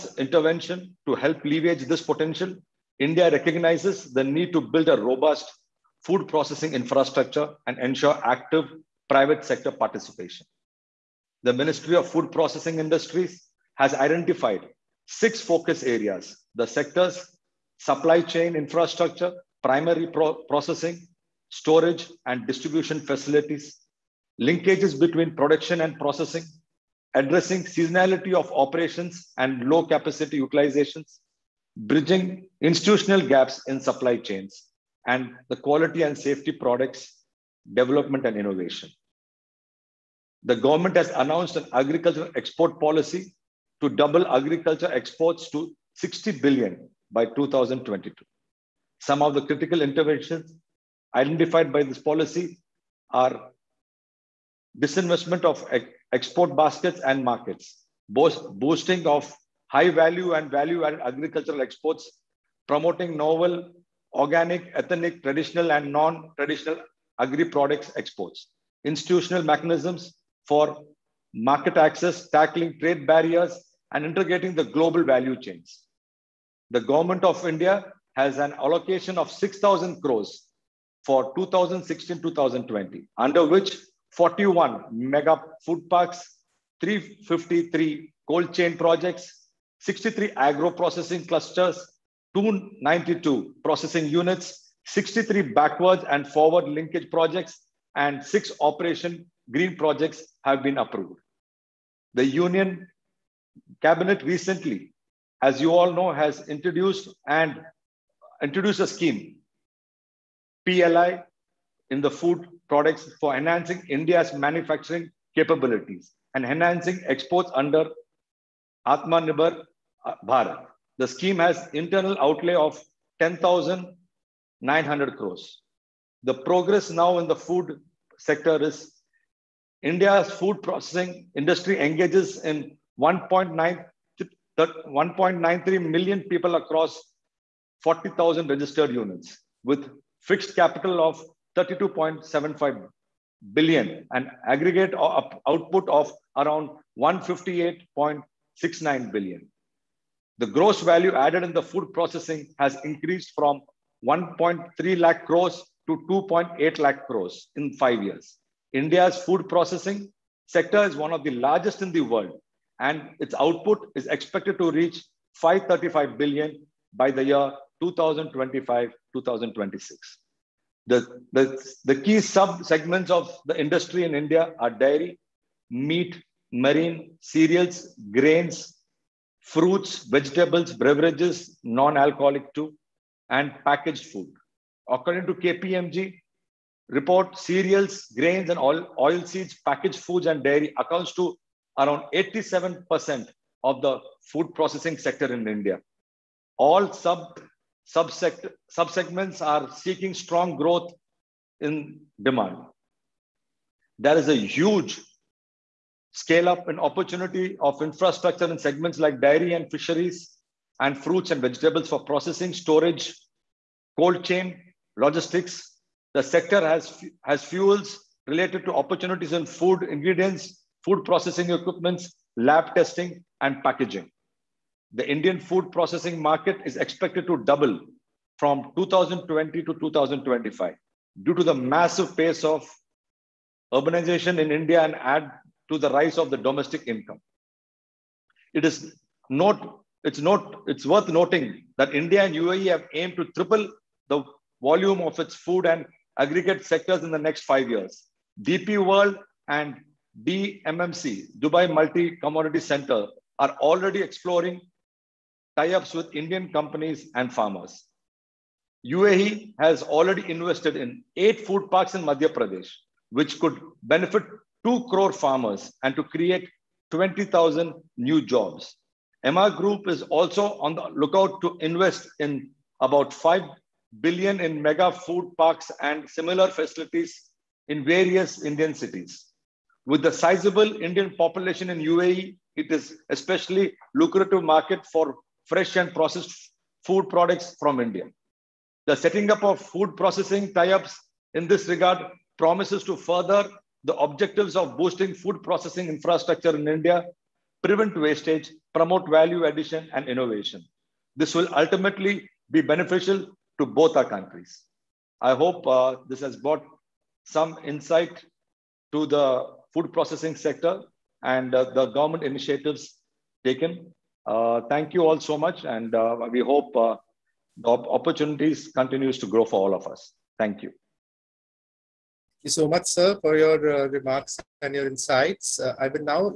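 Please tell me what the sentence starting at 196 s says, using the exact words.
All sub subsegments are seeking strong growth in demand.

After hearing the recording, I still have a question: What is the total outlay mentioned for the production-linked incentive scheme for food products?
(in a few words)
10,900 crores.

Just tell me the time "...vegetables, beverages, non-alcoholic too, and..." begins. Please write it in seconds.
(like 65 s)
180 s.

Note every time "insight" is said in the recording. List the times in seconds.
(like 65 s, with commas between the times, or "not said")
307 s, 324 s.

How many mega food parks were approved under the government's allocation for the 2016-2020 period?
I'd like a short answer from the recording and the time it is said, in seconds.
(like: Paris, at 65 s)
41, at 84 s.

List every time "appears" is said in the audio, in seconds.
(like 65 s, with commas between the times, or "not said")
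not said.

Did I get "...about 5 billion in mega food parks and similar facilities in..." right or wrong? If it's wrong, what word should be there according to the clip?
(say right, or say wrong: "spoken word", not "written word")
right.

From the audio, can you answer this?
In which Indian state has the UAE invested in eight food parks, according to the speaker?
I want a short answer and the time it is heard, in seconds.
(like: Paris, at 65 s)
Madhya Pradesh, at 262 s.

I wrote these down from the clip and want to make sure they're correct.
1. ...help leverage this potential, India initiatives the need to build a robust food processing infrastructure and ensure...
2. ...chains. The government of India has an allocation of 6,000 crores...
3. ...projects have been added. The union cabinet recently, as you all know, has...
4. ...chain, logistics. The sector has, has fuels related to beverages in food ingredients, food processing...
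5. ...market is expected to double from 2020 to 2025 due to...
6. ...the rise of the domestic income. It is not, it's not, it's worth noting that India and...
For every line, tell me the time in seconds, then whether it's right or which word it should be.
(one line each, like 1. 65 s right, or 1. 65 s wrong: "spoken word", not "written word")
1. 1 s wrong: "recognizes", not "initiatives"
2. 75 s right
3. 99 s wrong: "approved", not "added"
4. 214 s wrong: "opportunities", not "beverages"
5. 226 s right
6. 235 s right.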